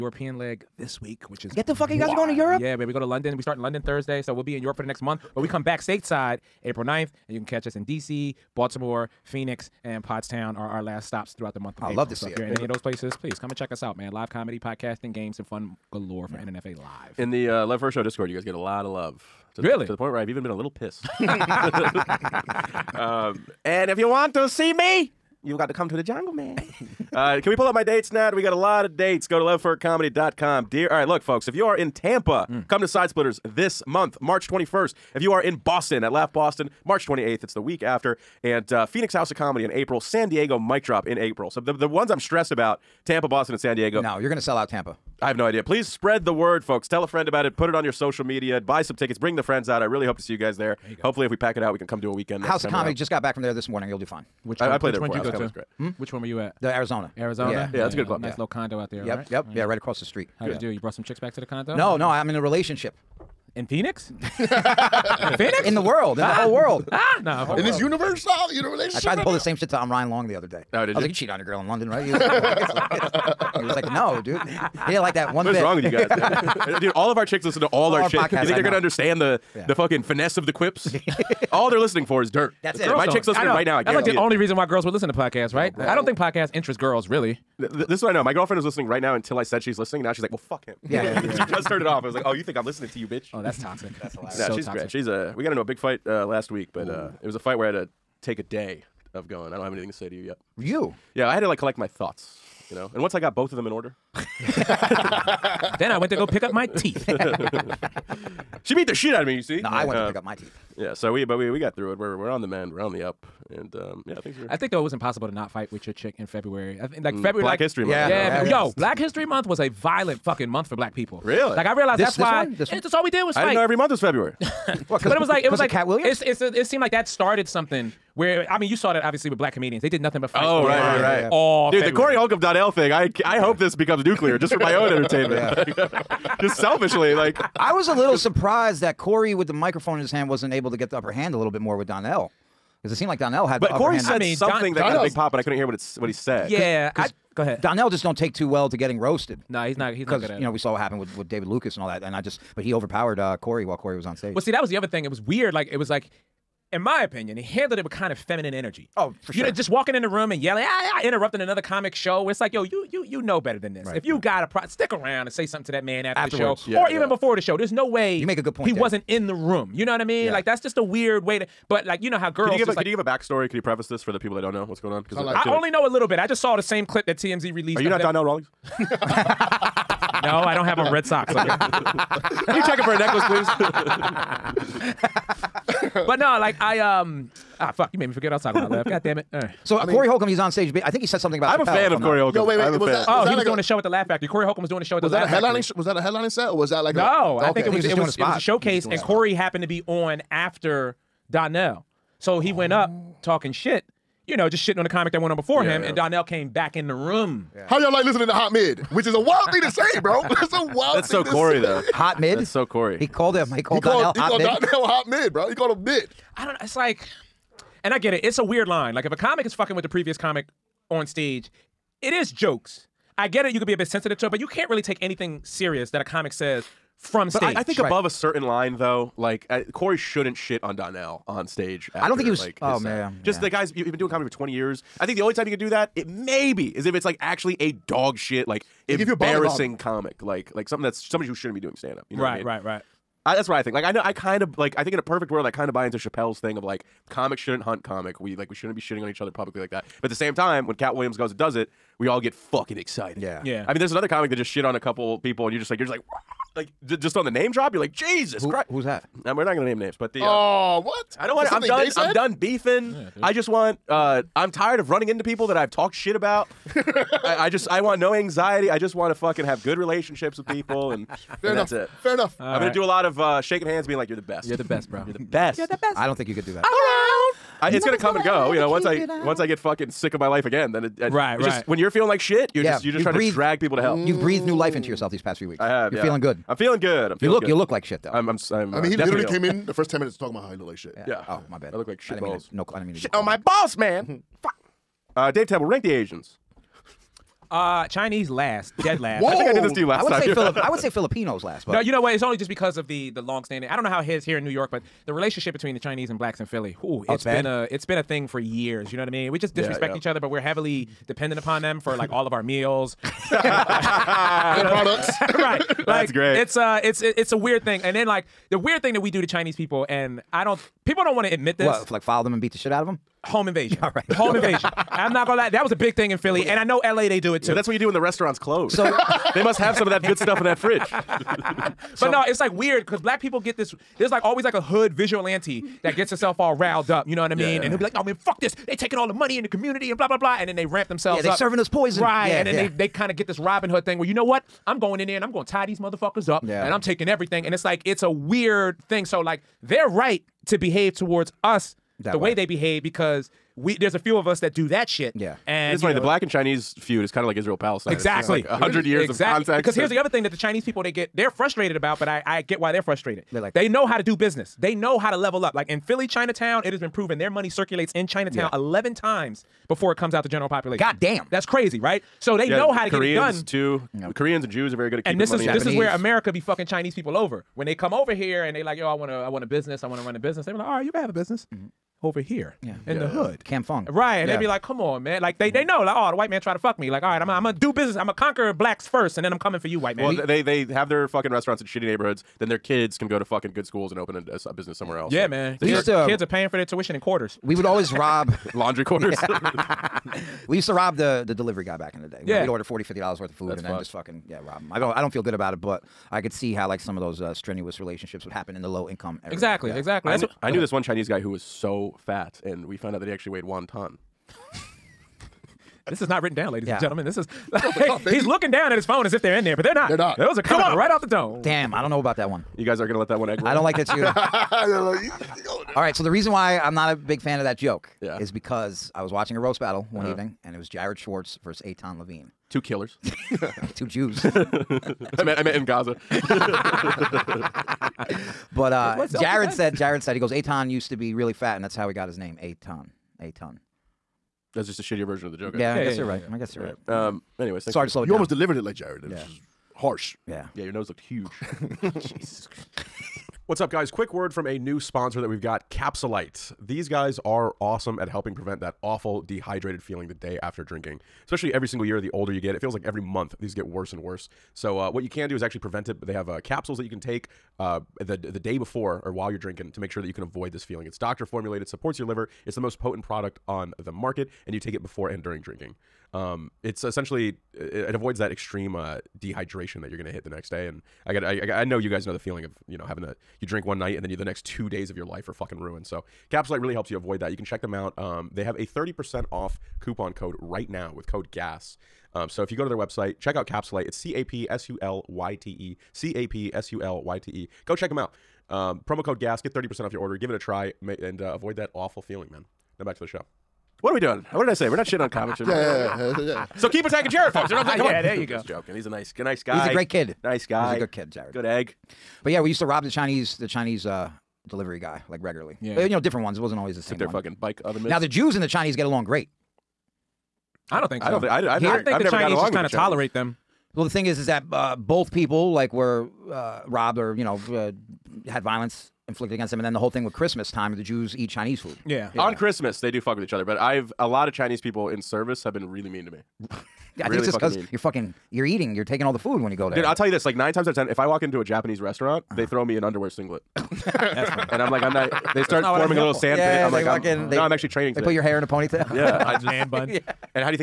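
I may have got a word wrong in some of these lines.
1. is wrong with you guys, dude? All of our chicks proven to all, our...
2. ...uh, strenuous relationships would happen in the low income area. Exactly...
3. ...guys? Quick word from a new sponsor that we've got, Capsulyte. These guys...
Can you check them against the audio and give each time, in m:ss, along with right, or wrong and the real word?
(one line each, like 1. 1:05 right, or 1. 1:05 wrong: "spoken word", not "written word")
1. 1:15 wrong: "listen", not "proven"
2. 6:47 right
3. 7:33 right.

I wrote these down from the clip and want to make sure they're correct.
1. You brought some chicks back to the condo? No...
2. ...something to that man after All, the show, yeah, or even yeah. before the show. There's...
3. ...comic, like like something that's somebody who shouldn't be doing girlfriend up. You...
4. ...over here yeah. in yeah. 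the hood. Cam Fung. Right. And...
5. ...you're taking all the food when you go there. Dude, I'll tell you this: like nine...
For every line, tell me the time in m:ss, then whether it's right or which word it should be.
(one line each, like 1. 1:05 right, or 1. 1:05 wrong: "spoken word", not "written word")
1. 1:00 right
2. 2:45 wrong: "Afterwards", not "All"
3. 3:59 wrong: "stand", not "girlfriend"
4. 6:22 right
5. 8:58 right.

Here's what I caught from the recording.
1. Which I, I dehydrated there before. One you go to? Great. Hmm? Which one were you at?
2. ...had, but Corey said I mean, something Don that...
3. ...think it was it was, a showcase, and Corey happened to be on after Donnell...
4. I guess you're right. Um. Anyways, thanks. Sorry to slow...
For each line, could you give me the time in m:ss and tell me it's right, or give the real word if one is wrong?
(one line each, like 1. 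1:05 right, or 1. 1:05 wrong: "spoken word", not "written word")
1. 0:54 wrong: "played", not "dehydrated"
2. 2:23 right
3. 3:17 right
4. 7:26 right.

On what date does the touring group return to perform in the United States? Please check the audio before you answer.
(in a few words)
April 9th.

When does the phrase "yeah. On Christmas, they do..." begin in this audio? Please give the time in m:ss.
8:52.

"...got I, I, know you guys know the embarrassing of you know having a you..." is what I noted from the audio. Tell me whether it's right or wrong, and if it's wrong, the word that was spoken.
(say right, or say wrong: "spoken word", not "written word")
wrong: "feeling", not "embarrassing".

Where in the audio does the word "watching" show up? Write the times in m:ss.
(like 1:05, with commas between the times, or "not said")
7:09.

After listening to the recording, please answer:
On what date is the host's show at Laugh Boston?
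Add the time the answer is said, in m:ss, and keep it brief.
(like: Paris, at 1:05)
March 28th, at 0:36.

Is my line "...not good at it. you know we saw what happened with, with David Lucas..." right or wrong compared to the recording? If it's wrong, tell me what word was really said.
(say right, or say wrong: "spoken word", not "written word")
right.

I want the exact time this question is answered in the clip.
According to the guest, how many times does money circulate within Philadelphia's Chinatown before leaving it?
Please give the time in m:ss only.
6:08.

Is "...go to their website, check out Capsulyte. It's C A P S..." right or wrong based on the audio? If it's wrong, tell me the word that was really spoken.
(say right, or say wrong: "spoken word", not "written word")
right.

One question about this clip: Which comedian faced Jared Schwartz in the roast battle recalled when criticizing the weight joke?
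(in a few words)
Aton Levine.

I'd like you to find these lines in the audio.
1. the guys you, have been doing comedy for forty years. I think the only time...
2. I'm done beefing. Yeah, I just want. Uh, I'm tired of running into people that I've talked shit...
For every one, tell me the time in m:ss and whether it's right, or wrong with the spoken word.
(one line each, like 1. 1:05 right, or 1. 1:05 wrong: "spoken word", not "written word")
1. 3:53 wrong: "twenty", not "forty"
2. 4:21 right.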